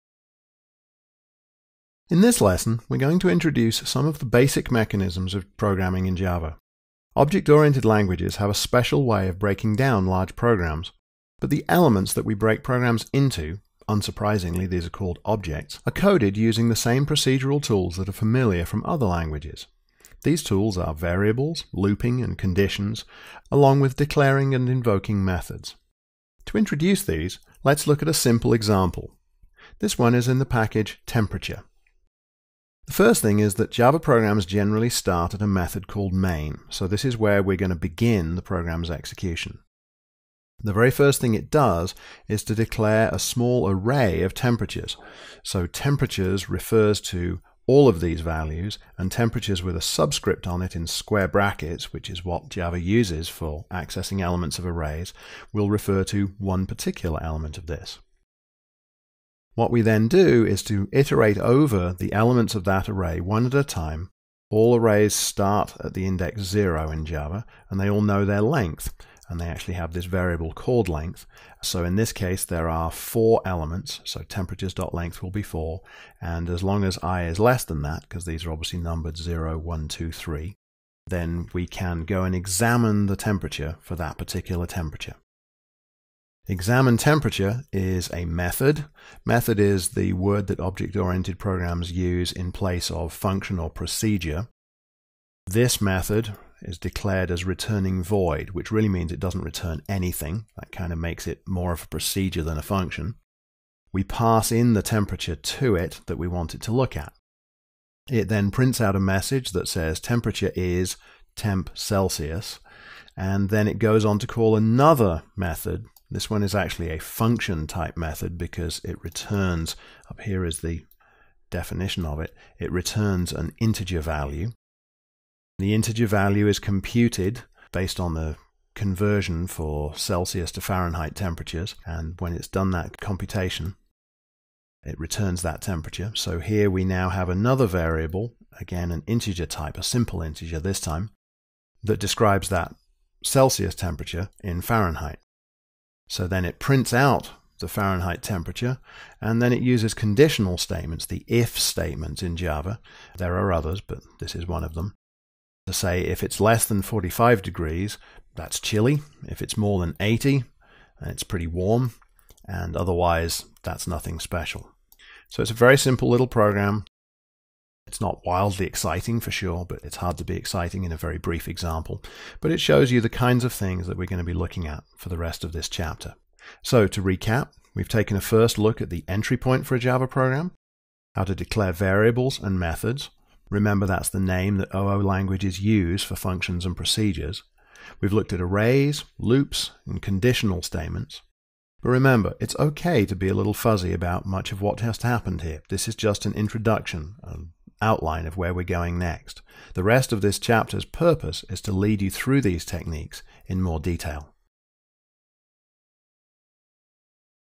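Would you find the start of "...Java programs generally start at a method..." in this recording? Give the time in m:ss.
0:33.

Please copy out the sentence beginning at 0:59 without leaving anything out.
What we then do is to iterate over the elements of that array one at a time.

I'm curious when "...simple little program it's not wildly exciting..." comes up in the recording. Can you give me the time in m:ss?
2:45.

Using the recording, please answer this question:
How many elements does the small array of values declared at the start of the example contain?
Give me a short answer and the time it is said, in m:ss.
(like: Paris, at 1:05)
4, at 1:12.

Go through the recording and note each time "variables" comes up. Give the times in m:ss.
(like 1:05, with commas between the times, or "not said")
0:20, 1:10, 2:17, 3:01.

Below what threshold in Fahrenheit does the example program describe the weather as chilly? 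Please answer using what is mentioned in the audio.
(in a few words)
45 degrees.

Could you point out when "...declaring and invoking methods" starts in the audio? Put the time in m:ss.
0:23.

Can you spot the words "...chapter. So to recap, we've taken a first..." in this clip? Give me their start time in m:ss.
2:55.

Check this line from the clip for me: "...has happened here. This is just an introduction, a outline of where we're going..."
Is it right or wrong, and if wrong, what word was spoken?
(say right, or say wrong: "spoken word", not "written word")
right.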